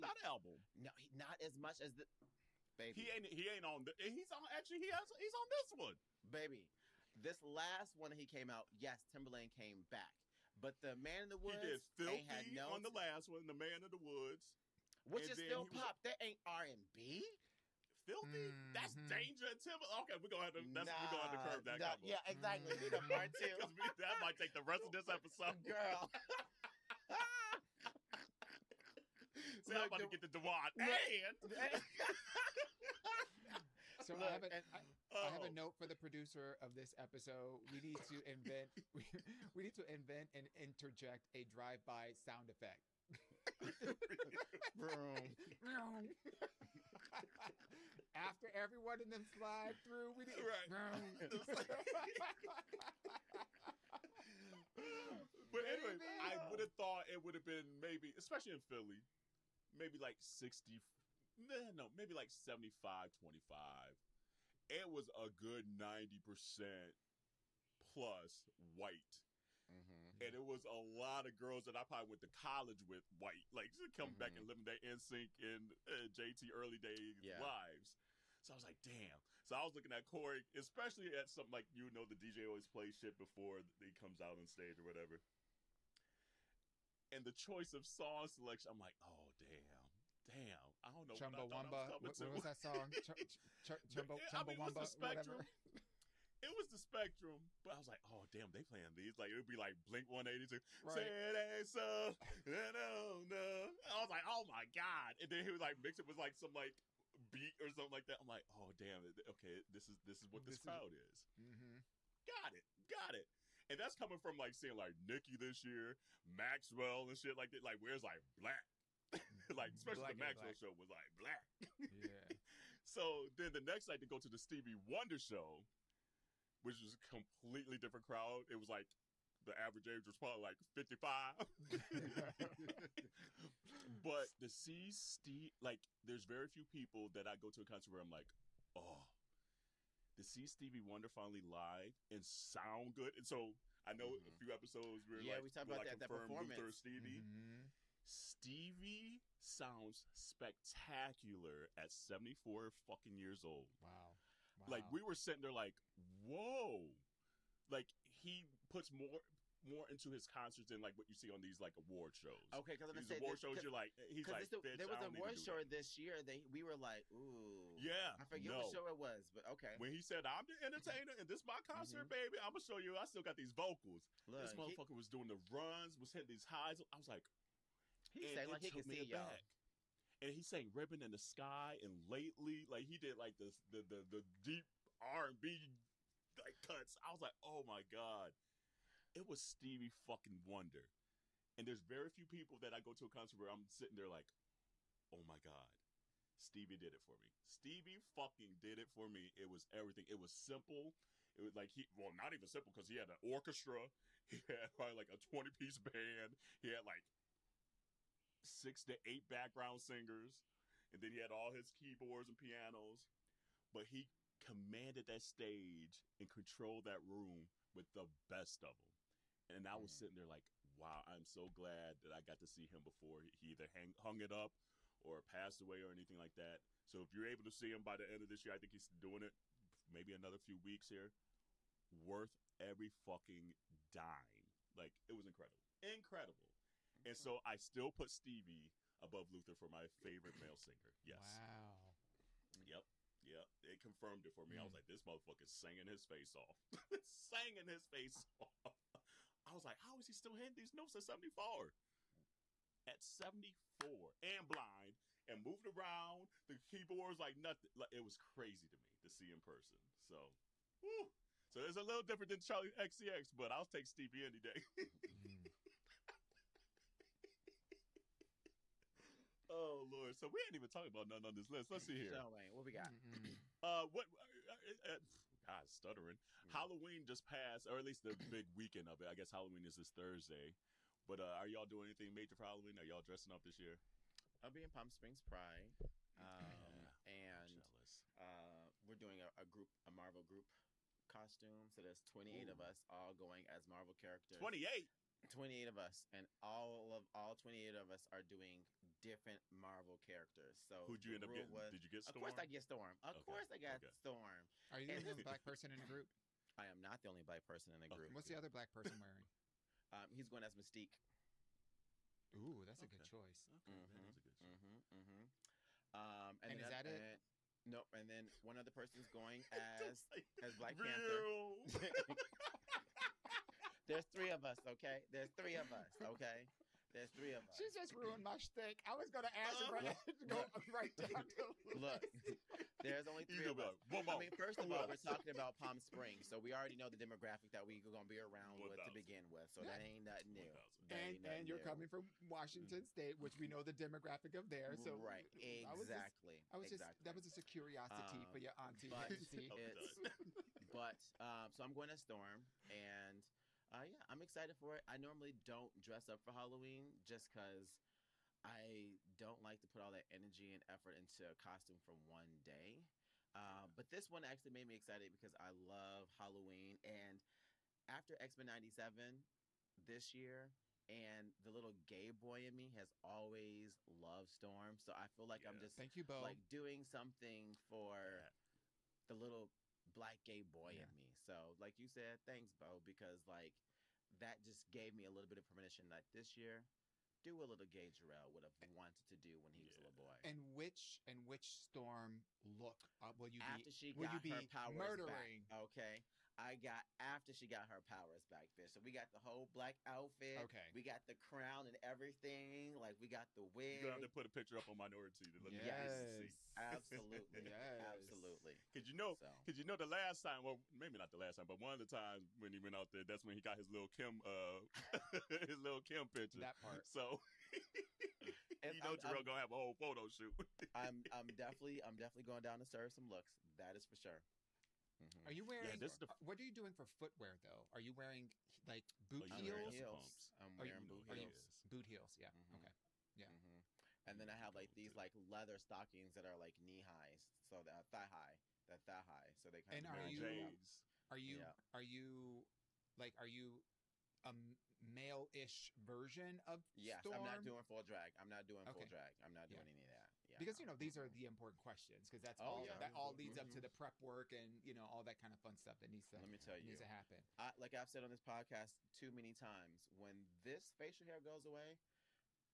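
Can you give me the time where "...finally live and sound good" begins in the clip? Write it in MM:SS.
02:21.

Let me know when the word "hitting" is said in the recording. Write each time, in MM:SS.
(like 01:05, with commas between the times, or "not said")
02:56, 04:10.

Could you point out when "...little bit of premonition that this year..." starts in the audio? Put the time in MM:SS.
06:25.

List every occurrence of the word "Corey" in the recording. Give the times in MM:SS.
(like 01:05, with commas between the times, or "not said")
01:20.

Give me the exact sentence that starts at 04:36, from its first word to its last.
Halloween just passed, or at least the big weekend of it.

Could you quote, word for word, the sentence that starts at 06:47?
absolutely because you know because so.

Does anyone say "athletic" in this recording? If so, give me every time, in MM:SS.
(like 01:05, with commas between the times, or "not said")
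not said.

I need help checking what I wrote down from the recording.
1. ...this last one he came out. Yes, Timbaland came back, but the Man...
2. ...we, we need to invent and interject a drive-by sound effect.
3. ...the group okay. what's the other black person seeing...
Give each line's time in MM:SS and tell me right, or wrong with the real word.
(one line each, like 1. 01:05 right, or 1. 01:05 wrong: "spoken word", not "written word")
1. 00:07 right
2. 00:38 right
3. 05:07 wrong: "wearing", not "seeing".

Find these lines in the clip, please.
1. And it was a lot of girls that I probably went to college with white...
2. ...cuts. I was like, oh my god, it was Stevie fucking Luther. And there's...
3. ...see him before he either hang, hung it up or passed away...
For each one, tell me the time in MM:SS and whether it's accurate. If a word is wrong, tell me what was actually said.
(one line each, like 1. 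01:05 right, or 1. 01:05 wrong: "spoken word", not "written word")
1. 01:10 right
2. 03:06 wrong: "Wonder", not "Luther"
3. 03:42 right.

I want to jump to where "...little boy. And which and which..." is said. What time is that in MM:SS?
06:29.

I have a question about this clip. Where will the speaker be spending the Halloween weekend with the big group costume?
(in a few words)
Palm Springs Pride.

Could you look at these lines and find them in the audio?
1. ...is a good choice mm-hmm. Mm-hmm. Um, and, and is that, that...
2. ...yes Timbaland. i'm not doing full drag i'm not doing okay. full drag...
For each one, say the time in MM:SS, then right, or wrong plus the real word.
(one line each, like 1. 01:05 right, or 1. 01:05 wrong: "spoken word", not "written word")
1. 05:14 right
2. 07:26 wrong: "Storm", not "Timbaland".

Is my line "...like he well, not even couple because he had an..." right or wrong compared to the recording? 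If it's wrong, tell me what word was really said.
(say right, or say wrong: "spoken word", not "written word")
wrong: "simple", not "couple".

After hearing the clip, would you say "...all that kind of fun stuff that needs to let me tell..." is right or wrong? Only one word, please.
right.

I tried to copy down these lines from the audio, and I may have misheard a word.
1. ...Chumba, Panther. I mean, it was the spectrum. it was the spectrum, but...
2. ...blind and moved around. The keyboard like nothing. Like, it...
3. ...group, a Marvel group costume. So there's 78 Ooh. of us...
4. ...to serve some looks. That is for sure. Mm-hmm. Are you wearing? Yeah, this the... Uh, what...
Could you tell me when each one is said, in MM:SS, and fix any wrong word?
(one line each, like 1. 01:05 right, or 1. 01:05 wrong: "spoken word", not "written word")
1. 01:33 wrong: "Chumbawamba", not "Panther"
2. 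04:14 right
3. 04:49 wrong: "28", not "78"
4. 07:02 right.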